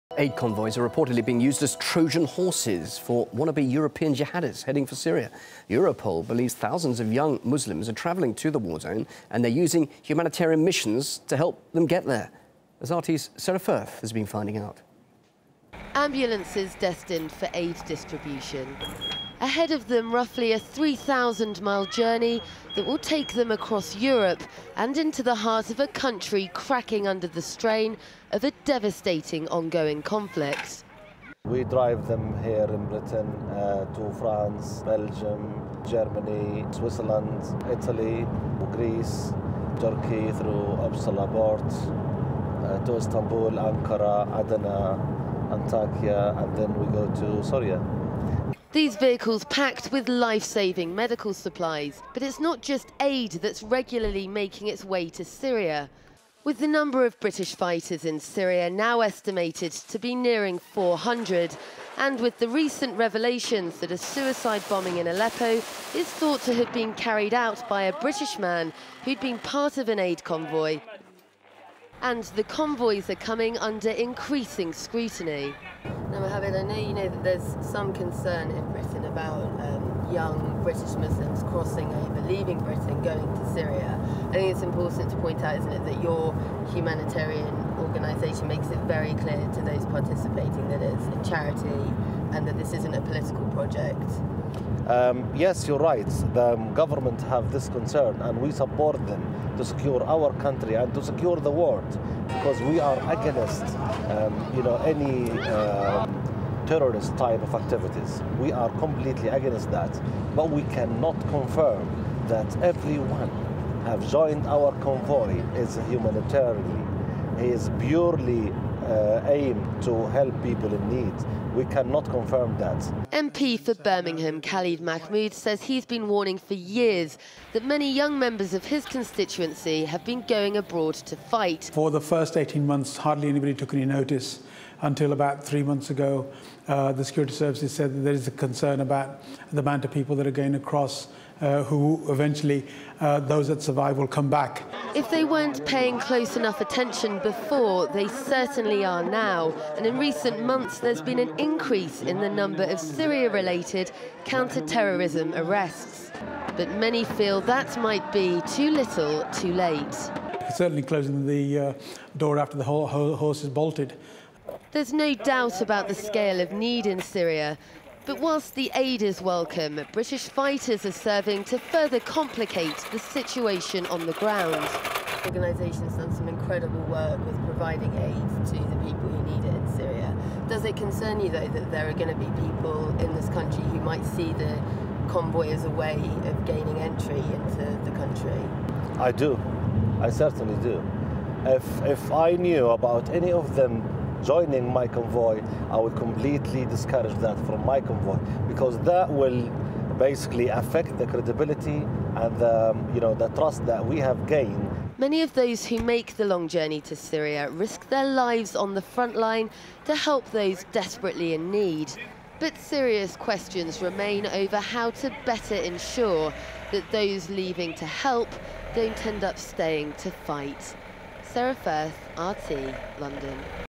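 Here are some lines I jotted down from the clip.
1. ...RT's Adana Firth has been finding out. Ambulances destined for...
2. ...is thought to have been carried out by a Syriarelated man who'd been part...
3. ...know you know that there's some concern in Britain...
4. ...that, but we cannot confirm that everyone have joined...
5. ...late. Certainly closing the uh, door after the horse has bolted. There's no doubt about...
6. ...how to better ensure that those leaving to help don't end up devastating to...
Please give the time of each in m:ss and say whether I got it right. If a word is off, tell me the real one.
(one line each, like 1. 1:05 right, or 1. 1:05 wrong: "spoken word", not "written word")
1. 0:12 wrong: "Sara", not "Adana"
2. 1:05 wrong: "British", not "Syriarelated"
3. 1:16 right
4. 1:49 right
5. 2:39 right
6. 3:34 wrong: "staying", not "devastating".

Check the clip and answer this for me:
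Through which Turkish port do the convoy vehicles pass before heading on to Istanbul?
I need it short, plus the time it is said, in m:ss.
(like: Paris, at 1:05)
Ipsala, at 0:40.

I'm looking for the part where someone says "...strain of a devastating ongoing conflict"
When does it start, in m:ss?
0:27.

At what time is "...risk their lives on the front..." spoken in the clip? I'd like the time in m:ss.
3:27.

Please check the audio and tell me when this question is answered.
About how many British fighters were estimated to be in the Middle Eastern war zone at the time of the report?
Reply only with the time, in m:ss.
1:00.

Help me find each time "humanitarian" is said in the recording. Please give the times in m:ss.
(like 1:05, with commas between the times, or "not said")
0:10, 1:26, 1:55.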